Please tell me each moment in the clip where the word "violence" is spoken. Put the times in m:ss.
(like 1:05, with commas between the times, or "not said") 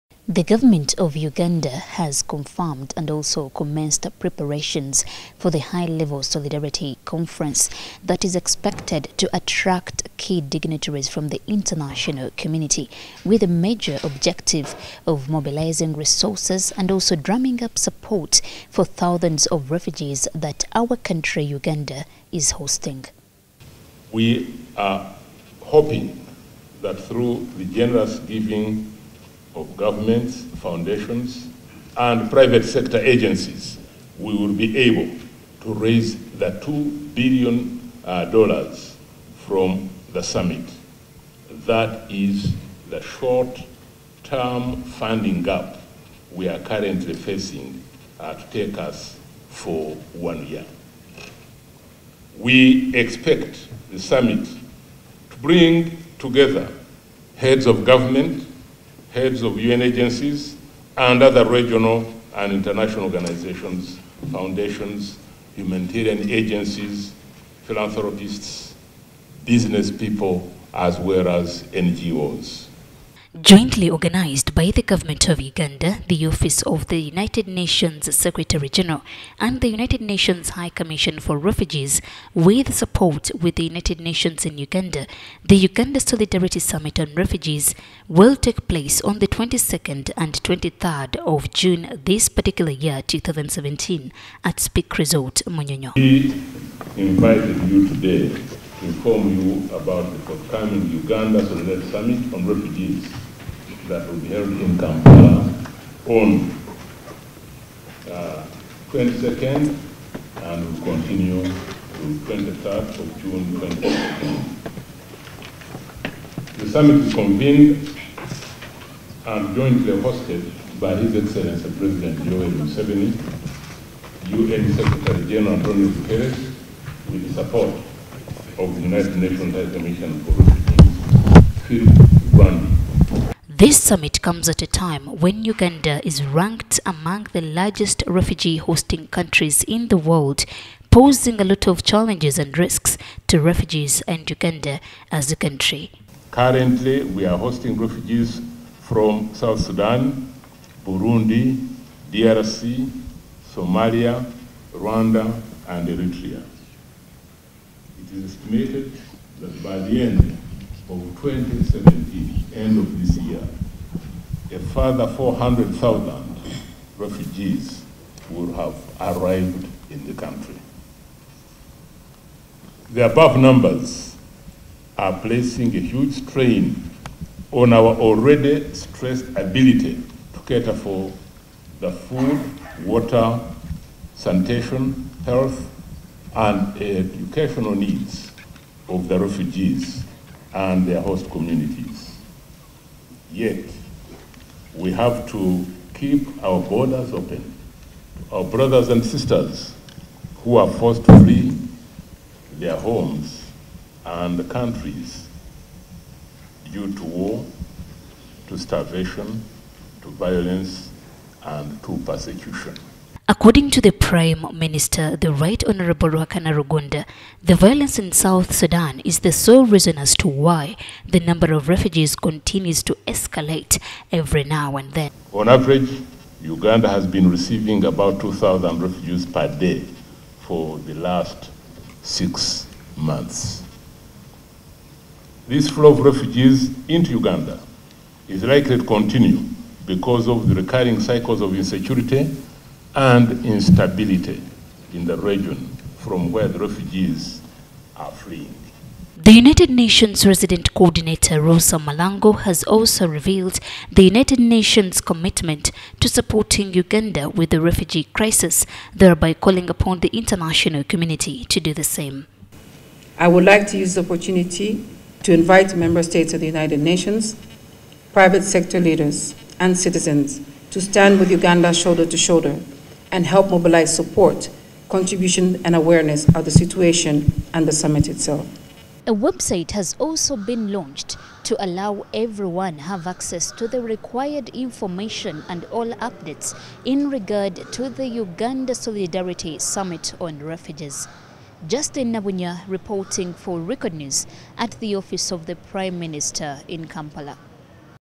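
3:30, 3:37.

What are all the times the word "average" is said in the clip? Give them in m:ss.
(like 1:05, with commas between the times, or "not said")
3:45.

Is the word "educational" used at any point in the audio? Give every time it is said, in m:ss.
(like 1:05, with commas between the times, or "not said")
3:06.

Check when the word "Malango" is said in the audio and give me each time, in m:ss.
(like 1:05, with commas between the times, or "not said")
4:11.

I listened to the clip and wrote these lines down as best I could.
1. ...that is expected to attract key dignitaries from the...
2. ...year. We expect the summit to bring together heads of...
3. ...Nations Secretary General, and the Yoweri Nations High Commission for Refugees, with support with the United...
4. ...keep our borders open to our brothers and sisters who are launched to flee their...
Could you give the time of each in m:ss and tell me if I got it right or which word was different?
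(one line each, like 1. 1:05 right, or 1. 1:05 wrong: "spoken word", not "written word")
1. 0:08 right
2. 0:50 right
3. 1:17 wrong: "United", not "Yoweri"
4. 3:15 wrong: "forced", not "launched".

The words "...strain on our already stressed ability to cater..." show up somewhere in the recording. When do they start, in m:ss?
2:56.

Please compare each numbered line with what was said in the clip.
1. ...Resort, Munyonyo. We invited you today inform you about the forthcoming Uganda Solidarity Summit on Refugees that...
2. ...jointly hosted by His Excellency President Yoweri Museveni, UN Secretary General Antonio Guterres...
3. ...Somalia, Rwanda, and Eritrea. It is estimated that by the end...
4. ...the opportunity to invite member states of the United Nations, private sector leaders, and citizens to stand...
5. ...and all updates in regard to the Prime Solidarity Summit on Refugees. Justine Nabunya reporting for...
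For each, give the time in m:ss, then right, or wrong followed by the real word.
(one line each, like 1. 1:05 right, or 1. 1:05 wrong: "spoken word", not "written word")
1. 1:34 right
2. 1:59 right
3. 2:33 right
4. 4:23 right
5. 4:45 wrong: "Uganda", not "Prime".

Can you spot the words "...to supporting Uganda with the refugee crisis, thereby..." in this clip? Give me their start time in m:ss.
4:15.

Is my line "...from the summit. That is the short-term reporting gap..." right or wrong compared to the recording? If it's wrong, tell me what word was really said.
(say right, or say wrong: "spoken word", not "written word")
wrong: "funding", not "reporting".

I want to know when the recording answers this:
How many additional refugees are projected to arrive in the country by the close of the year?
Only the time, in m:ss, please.
2:45.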